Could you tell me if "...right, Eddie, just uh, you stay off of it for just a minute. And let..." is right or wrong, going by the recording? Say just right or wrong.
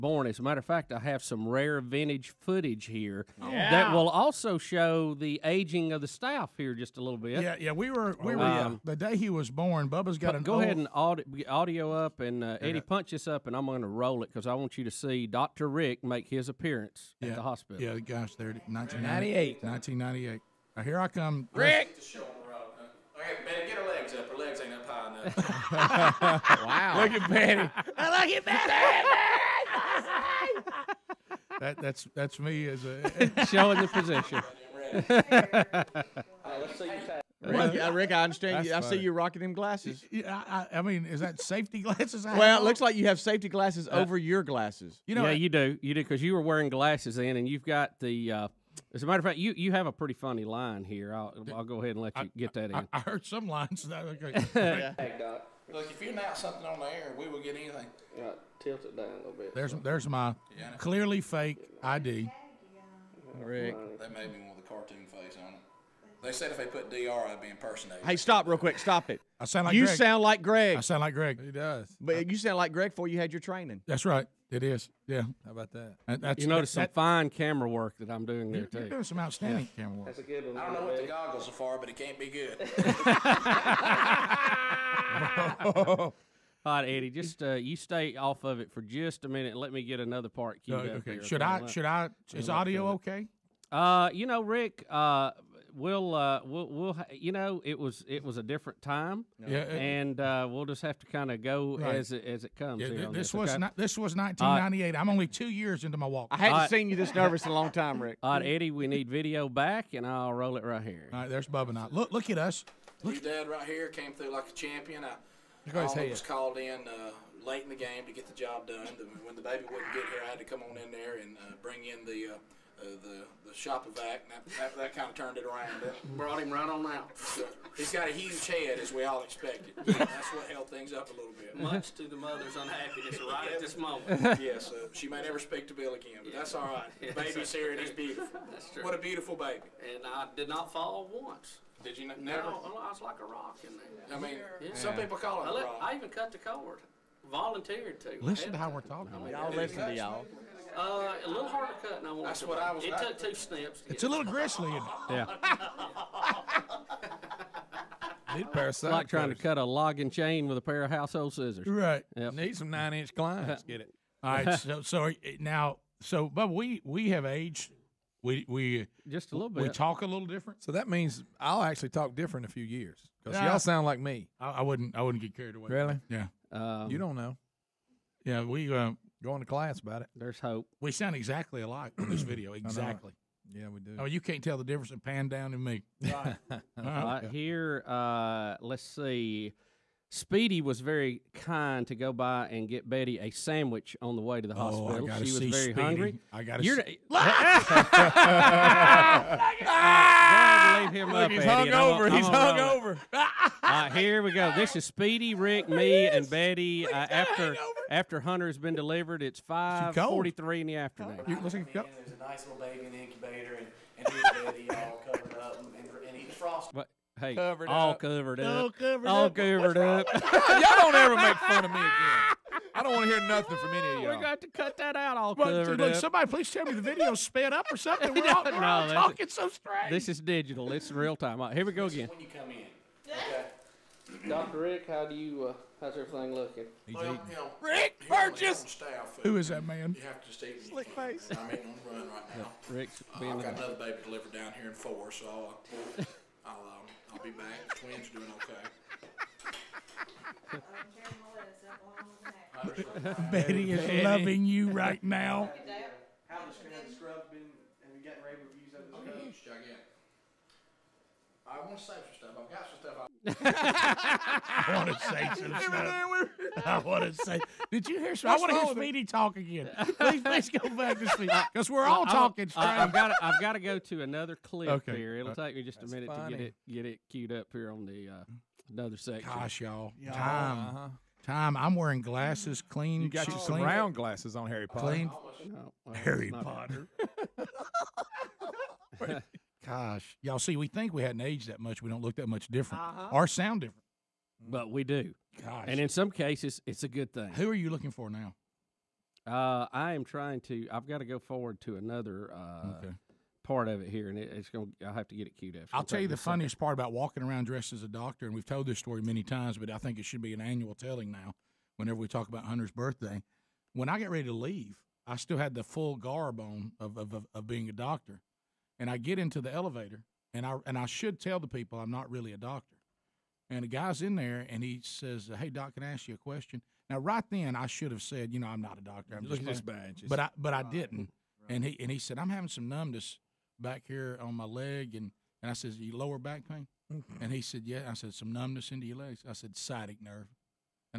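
right.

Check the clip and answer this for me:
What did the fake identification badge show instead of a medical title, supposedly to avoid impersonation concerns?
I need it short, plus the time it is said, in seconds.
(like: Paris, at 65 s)
a cartoon face, at 64 s.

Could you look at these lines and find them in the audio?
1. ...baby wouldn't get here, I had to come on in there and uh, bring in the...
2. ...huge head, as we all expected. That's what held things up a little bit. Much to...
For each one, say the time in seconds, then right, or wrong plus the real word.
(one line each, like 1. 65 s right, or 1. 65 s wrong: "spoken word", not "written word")
1. 119 s right
2. 128 s right.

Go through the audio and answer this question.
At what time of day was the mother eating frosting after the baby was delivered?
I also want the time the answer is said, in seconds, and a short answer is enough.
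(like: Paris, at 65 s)
5:43 in the afternoon, at 209 s.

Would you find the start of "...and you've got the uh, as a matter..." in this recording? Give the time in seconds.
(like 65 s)
47 s.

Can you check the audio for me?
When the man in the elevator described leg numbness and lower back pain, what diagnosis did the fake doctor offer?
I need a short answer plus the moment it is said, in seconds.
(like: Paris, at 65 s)
Sciatic nerve, at 339 s.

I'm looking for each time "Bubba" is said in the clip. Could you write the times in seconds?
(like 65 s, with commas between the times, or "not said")
9 s, 111 s.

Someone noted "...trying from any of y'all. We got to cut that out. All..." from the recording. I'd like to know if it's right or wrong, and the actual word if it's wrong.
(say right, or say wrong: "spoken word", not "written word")
wrong: "nothing", not "trying".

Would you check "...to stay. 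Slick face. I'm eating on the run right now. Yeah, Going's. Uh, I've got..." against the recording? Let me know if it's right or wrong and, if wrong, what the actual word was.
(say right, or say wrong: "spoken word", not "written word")
wrong: "Rick", not "Going".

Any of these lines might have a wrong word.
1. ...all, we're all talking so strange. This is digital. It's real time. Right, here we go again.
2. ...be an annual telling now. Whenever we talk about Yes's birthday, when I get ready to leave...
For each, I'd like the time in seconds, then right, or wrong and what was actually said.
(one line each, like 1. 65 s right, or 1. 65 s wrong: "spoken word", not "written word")
1. 228 s right
2. 310 s wrong: "Hunter", not "Yes".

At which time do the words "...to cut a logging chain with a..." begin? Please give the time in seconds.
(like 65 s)
159 s.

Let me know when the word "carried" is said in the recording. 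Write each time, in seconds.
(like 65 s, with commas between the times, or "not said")
175 s.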